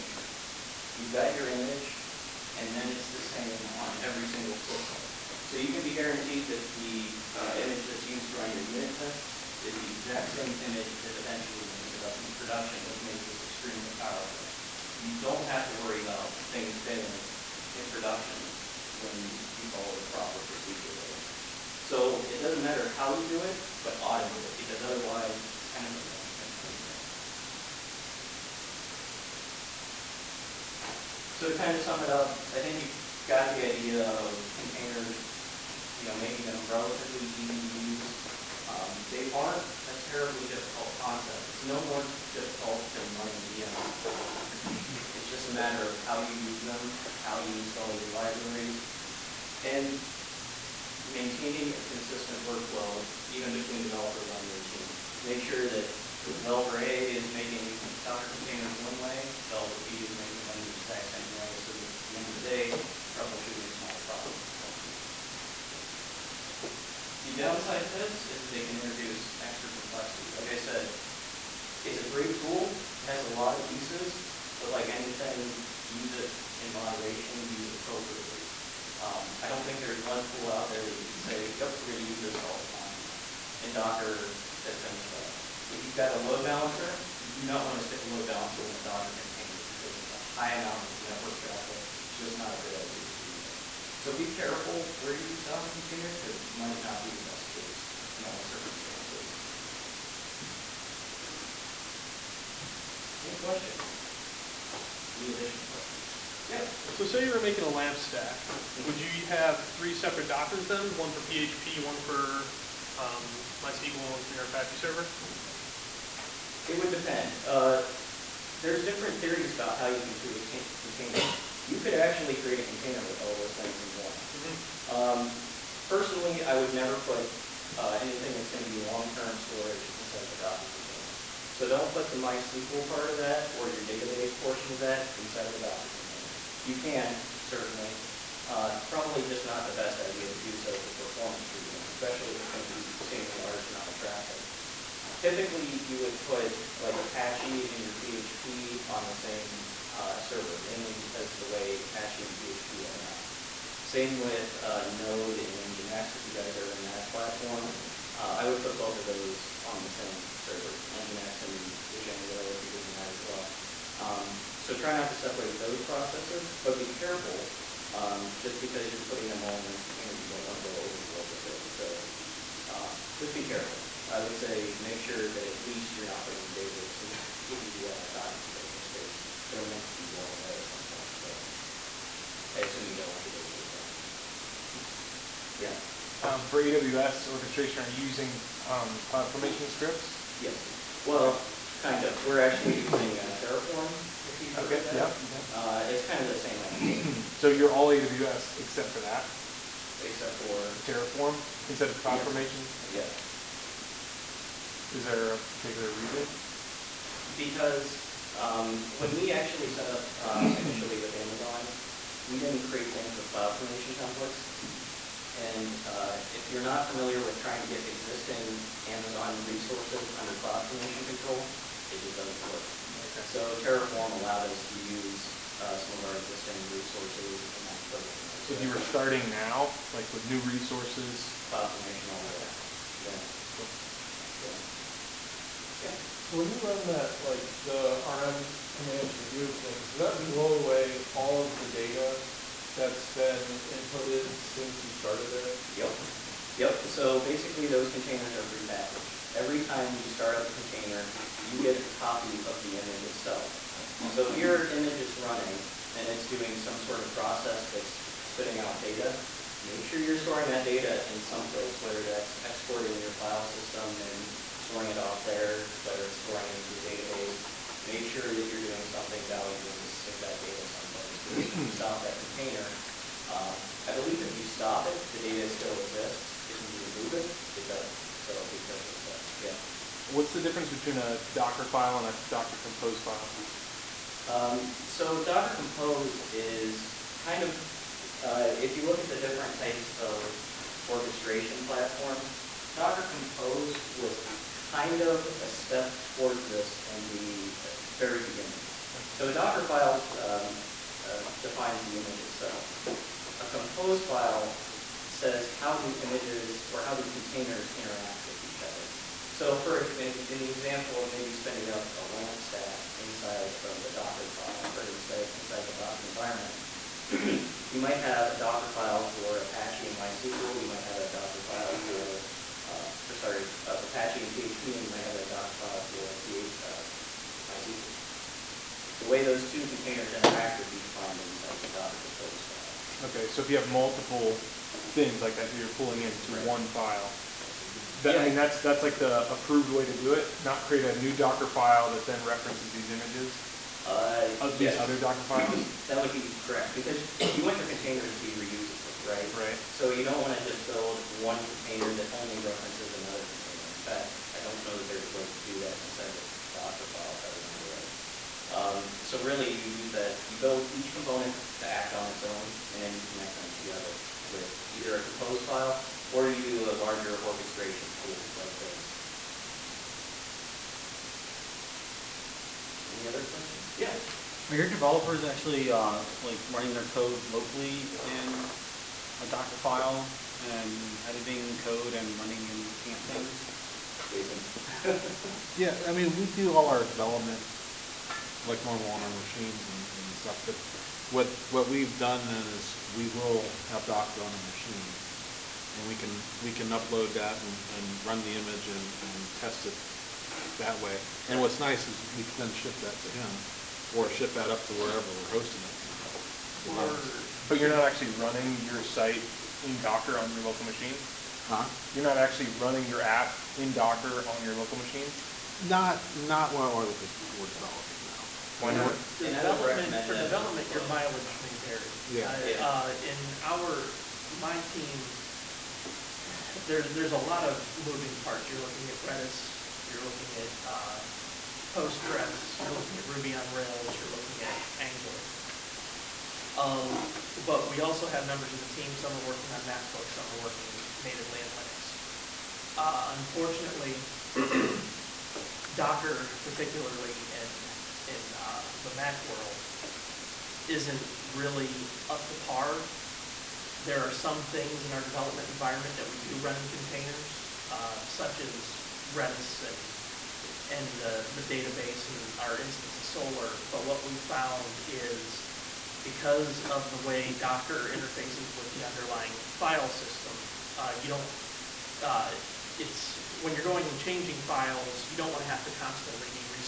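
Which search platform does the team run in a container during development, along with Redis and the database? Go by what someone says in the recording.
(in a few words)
Solr.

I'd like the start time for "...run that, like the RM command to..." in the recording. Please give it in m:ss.
3:56.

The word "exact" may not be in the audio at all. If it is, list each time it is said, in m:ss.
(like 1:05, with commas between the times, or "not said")
0:09, 1:00.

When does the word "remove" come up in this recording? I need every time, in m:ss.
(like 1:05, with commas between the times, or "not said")
3:59, 4:37.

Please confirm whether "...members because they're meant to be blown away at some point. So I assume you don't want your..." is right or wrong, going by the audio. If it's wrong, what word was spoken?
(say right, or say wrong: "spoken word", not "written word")
wrong: "containers", not "members".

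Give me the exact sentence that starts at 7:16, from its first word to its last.
Um, but we also have members of the team, some are working on MacBooks, some are working in, natively in Linux.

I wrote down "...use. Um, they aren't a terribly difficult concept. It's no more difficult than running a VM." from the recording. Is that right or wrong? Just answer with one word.
right.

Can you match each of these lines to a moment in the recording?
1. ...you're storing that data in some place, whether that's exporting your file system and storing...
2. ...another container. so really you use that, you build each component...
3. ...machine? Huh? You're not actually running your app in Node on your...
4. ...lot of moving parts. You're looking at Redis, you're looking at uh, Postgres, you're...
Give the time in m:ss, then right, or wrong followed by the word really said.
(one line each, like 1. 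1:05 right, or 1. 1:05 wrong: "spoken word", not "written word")
1. 4:19 right
2. 5:52 right
3. 6:50 wrong: "Docker", not "Node"
4. 7:07 right.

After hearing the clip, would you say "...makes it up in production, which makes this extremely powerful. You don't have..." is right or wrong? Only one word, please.
right.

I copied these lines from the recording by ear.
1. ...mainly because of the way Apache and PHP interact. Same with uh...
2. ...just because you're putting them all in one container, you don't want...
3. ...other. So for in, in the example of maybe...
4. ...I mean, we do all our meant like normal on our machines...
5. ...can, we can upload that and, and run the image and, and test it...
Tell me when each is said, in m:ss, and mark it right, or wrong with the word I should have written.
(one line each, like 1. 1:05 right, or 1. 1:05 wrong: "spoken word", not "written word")
1. 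2:30 right
2. 2:48 right
3. 5:08 right
4. 6:25 wrong: "development", not "meant"
5. 6:35 right.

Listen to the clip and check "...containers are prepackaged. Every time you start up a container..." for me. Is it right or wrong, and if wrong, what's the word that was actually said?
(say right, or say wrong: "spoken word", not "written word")
right.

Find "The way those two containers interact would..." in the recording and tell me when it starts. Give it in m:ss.
5:28.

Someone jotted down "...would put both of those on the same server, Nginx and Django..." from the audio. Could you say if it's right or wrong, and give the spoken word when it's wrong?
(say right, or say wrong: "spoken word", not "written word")
right.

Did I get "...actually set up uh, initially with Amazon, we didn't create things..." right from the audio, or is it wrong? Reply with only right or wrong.
right.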